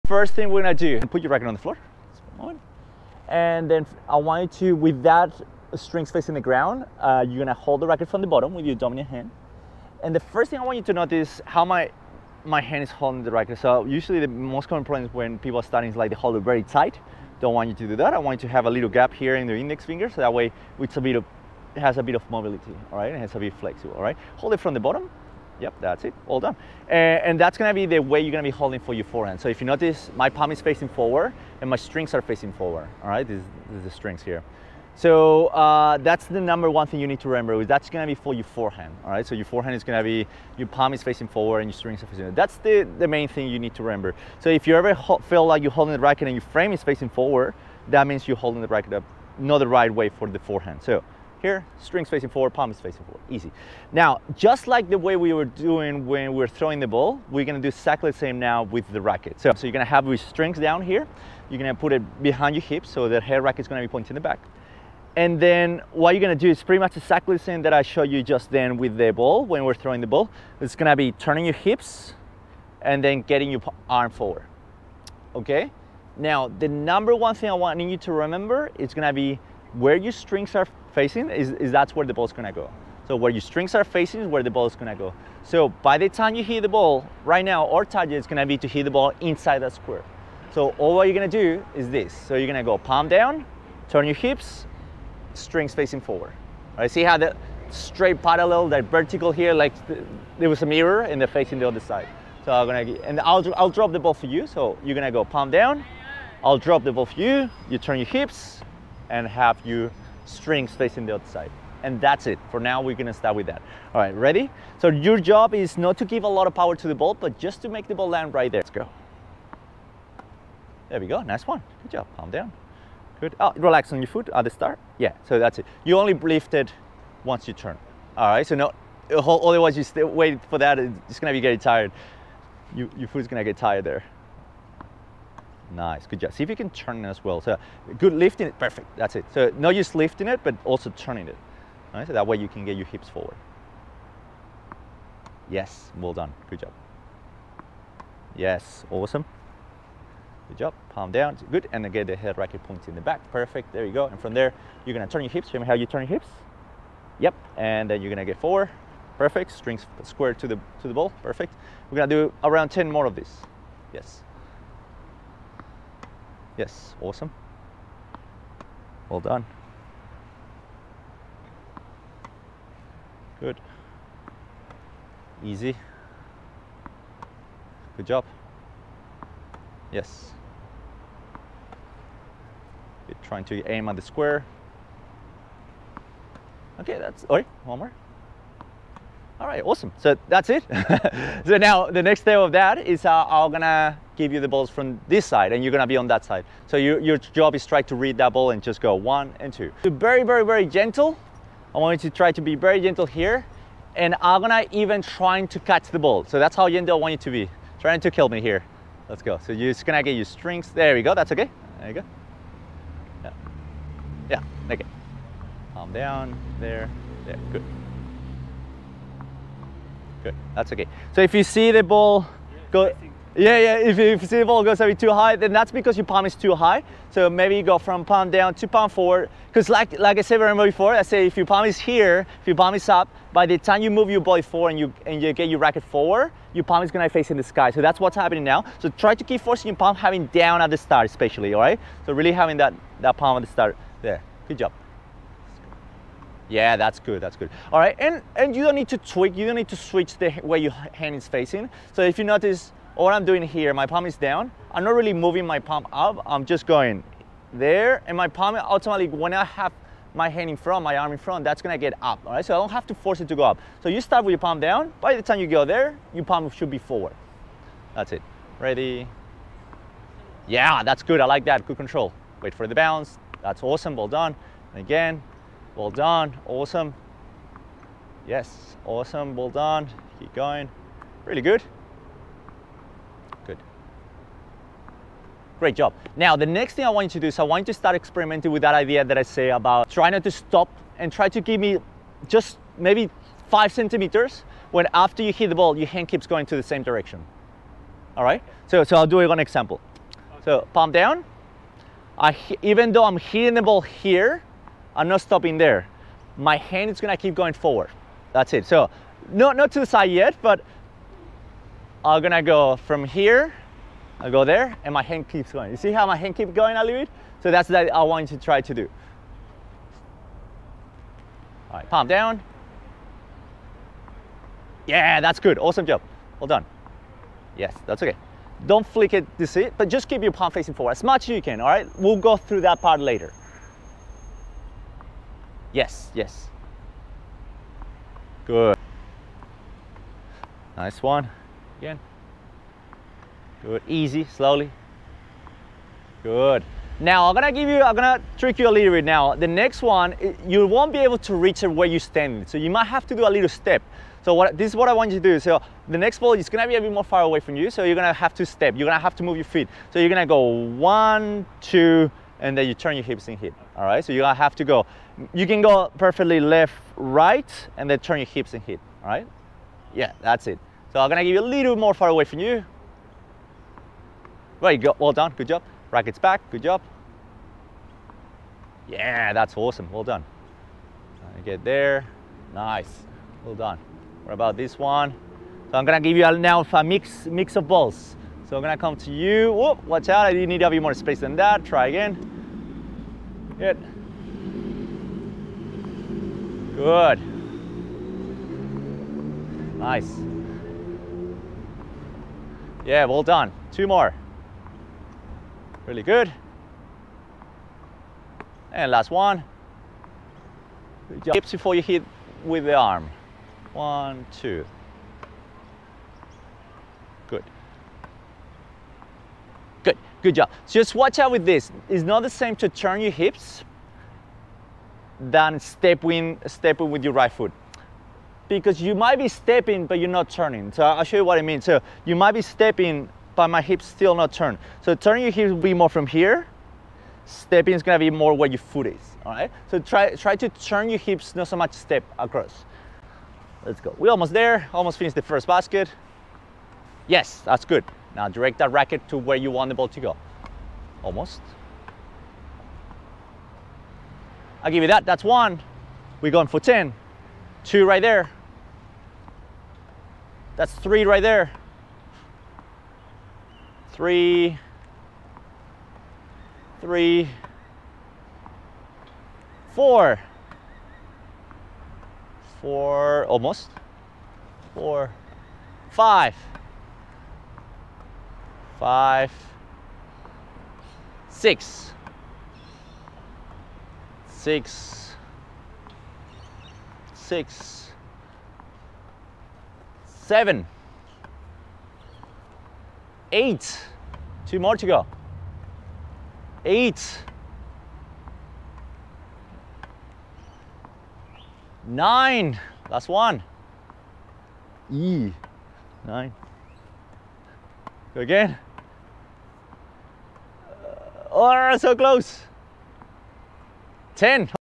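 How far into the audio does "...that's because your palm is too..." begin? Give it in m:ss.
3:45.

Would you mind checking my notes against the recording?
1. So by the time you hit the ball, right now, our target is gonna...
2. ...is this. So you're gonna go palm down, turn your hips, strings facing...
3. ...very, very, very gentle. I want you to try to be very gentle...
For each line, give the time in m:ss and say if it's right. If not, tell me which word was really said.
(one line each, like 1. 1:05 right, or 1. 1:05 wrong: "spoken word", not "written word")
1. 1:25 right
2. 1:31 right
3. 3:19 right.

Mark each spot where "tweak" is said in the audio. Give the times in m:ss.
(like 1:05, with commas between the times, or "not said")
4:08.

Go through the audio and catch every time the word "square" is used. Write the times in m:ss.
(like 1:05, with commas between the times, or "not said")
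1:29, 2:40, 3:04.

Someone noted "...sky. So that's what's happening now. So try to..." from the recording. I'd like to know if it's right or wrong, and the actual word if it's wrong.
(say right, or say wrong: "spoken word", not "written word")
right.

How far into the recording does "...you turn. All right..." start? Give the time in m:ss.
2:07.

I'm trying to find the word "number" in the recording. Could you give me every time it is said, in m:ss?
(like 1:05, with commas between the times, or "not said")
0:36, 1:16.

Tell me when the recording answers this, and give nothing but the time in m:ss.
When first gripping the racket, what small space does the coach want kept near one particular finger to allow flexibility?
0:18.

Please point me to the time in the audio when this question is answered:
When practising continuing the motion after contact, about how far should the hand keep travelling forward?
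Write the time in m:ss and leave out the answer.
4:53.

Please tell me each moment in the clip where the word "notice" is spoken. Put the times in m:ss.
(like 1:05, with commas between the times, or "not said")
0:10, 0:29, 4:12.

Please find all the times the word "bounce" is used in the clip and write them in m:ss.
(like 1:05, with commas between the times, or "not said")
4:32.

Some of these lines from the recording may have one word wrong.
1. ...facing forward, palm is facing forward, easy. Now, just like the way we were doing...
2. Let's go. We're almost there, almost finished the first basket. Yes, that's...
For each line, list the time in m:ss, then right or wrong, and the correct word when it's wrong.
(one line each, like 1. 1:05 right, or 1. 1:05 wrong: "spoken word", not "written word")
1. 0:52 right
2. 7:23 right.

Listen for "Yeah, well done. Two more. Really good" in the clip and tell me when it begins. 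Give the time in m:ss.
6:42.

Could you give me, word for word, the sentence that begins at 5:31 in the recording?
We'll go through that part later.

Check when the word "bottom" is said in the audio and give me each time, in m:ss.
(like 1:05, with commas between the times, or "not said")
0:08, 0:24.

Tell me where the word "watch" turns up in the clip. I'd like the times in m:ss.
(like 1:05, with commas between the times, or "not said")
6:29, 7:00.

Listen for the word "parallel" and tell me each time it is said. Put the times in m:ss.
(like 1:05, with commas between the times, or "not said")
1:38.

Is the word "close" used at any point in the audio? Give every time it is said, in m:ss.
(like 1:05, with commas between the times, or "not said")
8:31.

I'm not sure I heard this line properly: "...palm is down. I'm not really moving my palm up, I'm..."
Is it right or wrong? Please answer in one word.
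right.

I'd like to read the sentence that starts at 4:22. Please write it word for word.
So I don't have to force it to go up.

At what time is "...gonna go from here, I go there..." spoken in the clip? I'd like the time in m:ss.
5:12.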